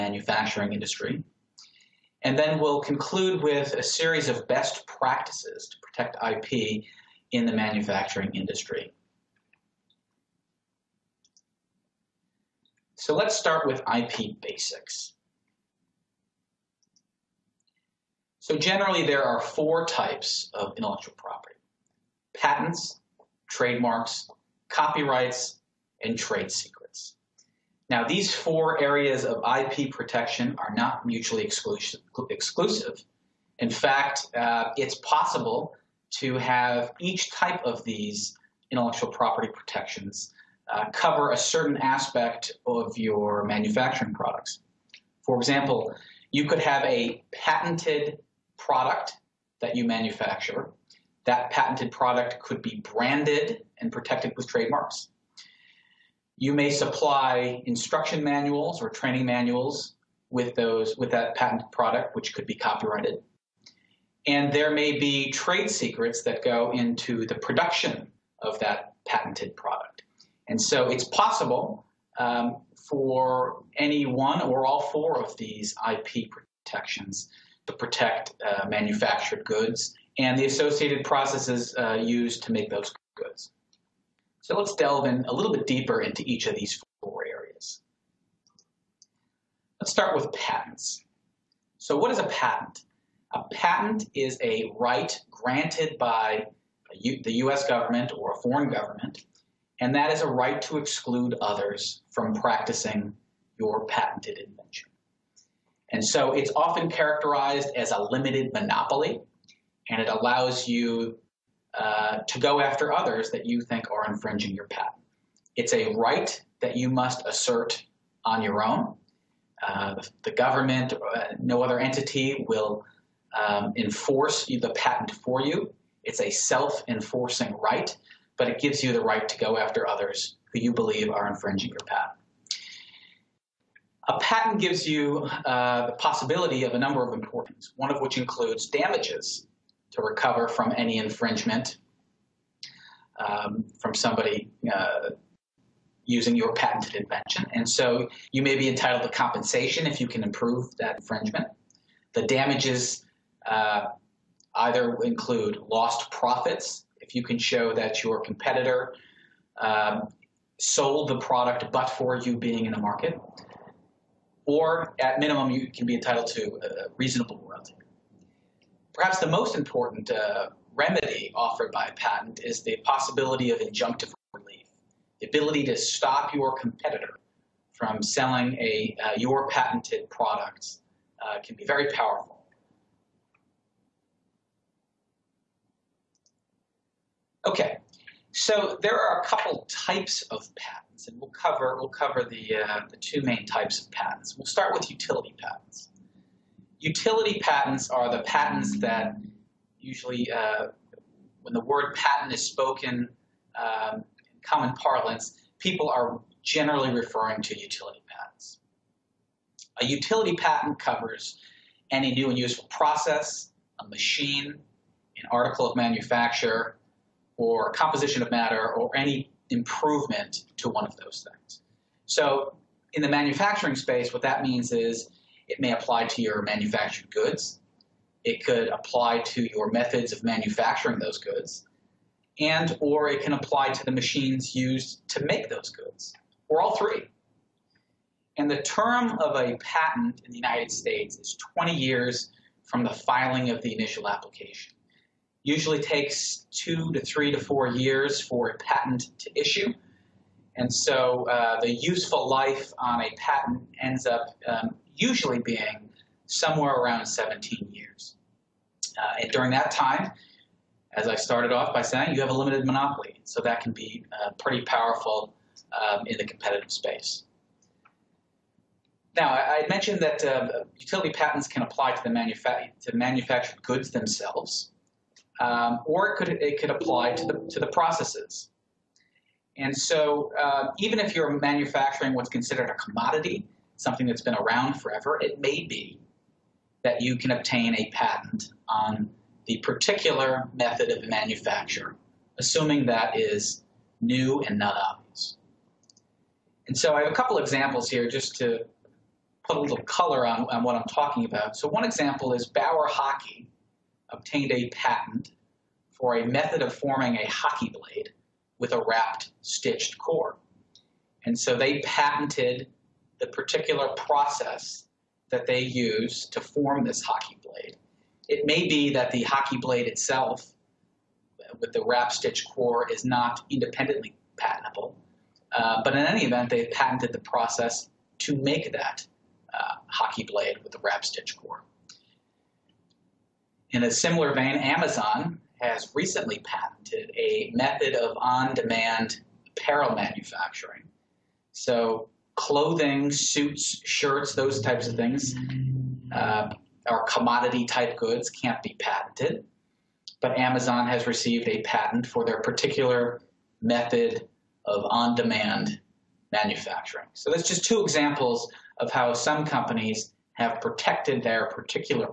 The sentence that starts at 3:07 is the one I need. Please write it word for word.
Okay, so there are a couple types of patents, and we'll cover, we'll cover the, uh, the two main types of patents.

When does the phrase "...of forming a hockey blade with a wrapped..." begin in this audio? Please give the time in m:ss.
5:06.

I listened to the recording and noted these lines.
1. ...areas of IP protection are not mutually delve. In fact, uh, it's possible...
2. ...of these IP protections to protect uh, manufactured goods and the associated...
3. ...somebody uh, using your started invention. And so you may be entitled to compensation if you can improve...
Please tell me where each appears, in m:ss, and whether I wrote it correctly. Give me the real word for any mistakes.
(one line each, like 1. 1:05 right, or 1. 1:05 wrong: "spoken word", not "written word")
1. 0:28 wrong: "exclusive", not "delve"
2. 1:15 right
3. 2:23 wrong: "patented", not "started".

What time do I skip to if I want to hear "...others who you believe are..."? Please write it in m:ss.
2:09.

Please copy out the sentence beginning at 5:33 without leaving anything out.
In a similar vein, Amazon has recently patented a method of on demand apparel manufacturing.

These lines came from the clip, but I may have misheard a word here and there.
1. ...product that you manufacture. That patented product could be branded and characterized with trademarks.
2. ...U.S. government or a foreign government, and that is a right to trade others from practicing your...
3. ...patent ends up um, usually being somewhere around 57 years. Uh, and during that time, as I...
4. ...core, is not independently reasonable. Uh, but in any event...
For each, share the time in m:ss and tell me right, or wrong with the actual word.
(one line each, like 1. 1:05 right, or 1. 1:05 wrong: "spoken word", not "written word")
1. 0:48 wrong: "protected", not "characterized"
2. 1:37 wrong: "exclude", not "trade"
3. 4:13 wrong: "17", not "57"
4. 5:22 wrong: "patentable", not "reasonable".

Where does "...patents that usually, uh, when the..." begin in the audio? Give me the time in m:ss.
3:18.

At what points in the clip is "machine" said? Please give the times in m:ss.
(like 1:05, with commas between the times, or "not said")
3:33, 3:53.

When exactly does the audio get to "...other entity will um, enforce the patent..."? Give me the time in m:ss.
2:01.